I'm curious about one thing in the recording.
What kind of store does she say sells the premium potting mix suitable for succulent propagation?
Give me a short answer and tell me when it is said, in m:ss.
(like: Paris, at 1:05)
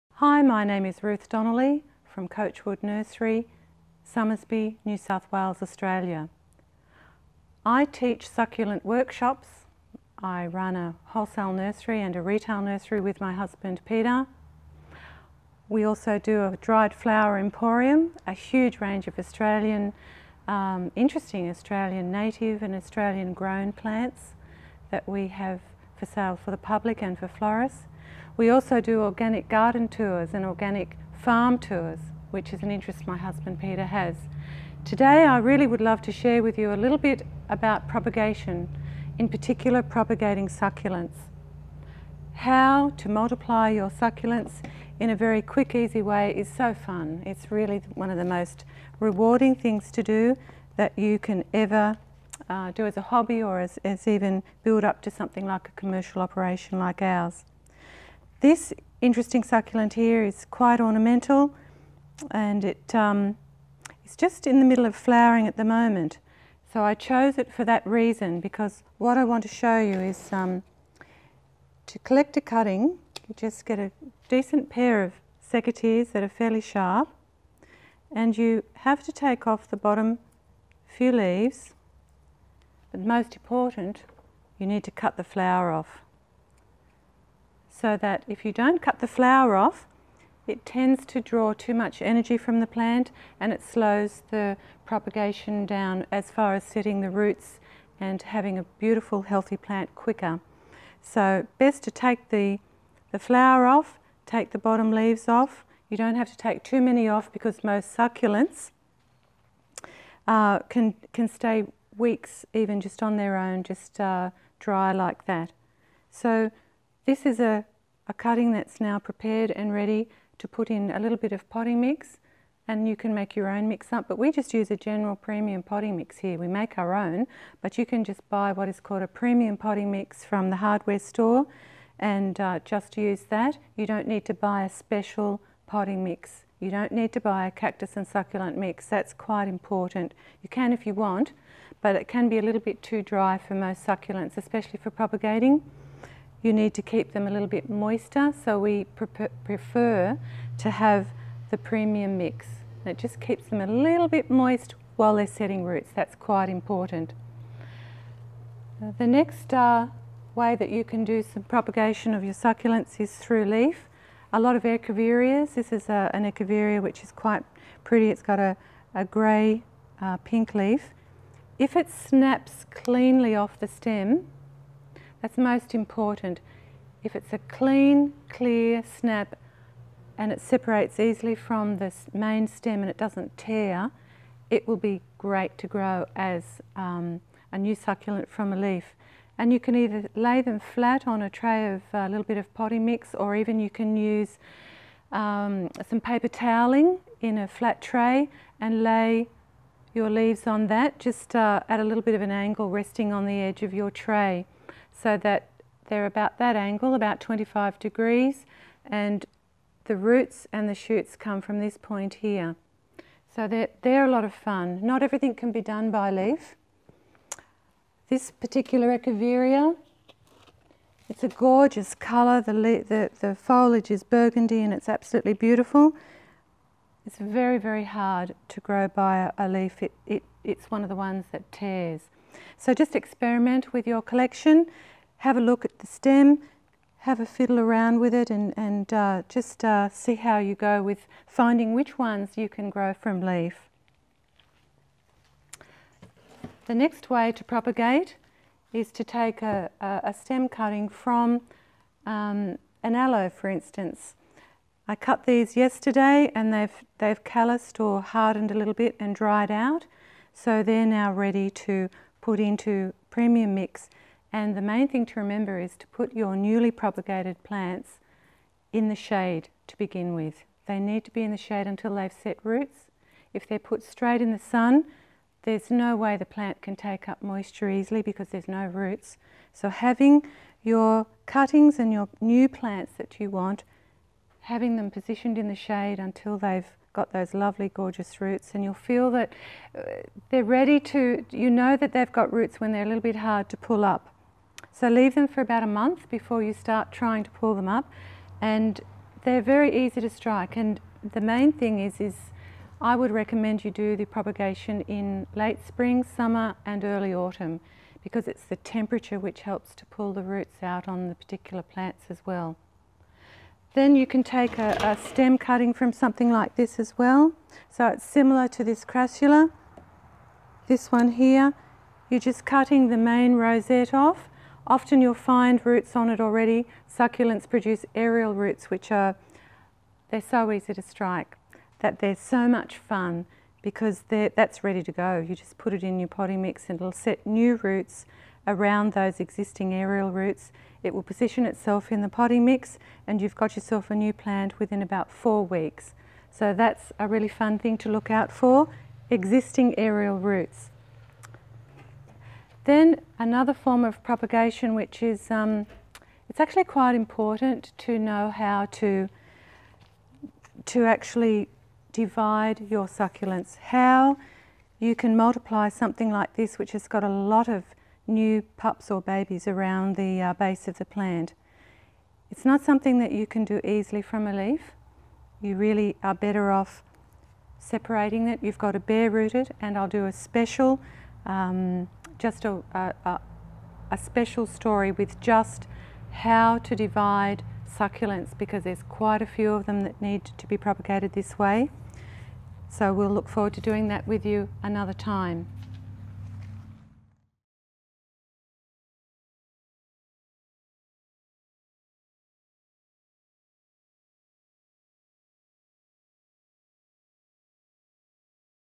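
Hardware store, at 2:10.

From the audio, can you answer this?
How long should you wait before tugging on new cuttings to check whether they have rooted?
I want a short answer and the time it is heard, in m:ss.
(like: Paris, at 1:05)
About a month, at 4:55.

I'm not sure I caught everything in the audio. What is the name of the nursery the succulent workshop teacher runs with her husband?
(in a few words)
Coachwood Nursery.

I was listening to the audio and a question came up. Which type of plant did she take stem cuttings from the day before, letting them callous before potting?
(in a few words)
Aloe.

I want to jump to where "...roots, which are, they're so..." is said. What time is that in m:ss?
5:28.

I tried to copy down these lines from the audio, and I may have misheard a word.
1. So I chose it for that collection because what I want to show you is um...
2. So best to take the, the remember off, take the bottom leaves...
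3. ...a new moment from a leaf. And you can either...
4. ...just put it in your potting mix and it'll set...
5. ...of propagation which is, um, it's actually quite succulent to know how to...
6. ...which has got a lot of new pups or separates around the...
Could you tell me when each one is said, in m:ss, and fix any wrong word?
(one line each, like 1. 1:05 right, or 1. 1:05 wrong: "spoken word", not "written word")
1. 1:06 wrong: "reason", not "collection"
2. 1:41 wrong: "flower", not "remember"
3. 3:07 wrong: "succulent", not "moment"
4. 5:35 right
5. 5:53 wrong: "important", not "succulent"
6. 6:06 wrong: "babies", not "separates".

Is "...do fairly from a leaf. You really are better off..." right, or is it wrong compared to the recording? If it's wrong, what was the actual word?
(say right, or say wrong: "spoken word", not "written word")
wrong: "easily", not "fairly".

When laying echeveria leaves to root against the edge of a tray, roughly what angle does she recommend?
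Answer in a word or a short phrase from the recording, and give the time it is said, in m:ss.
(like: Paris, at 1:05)
25 degrees, at 3:27.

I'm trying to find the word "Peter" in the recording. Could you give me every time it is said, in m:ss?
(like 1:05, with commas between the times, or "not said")
0:13, 0:33.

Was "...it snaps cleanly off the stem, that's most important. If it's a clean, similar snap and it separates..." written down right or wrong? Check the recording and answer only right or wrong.
wrong.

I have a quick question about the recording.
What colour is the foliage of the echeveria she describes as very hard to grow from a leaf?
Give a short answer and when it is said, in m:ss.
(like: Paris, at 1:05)
Burgundy, at 3:44.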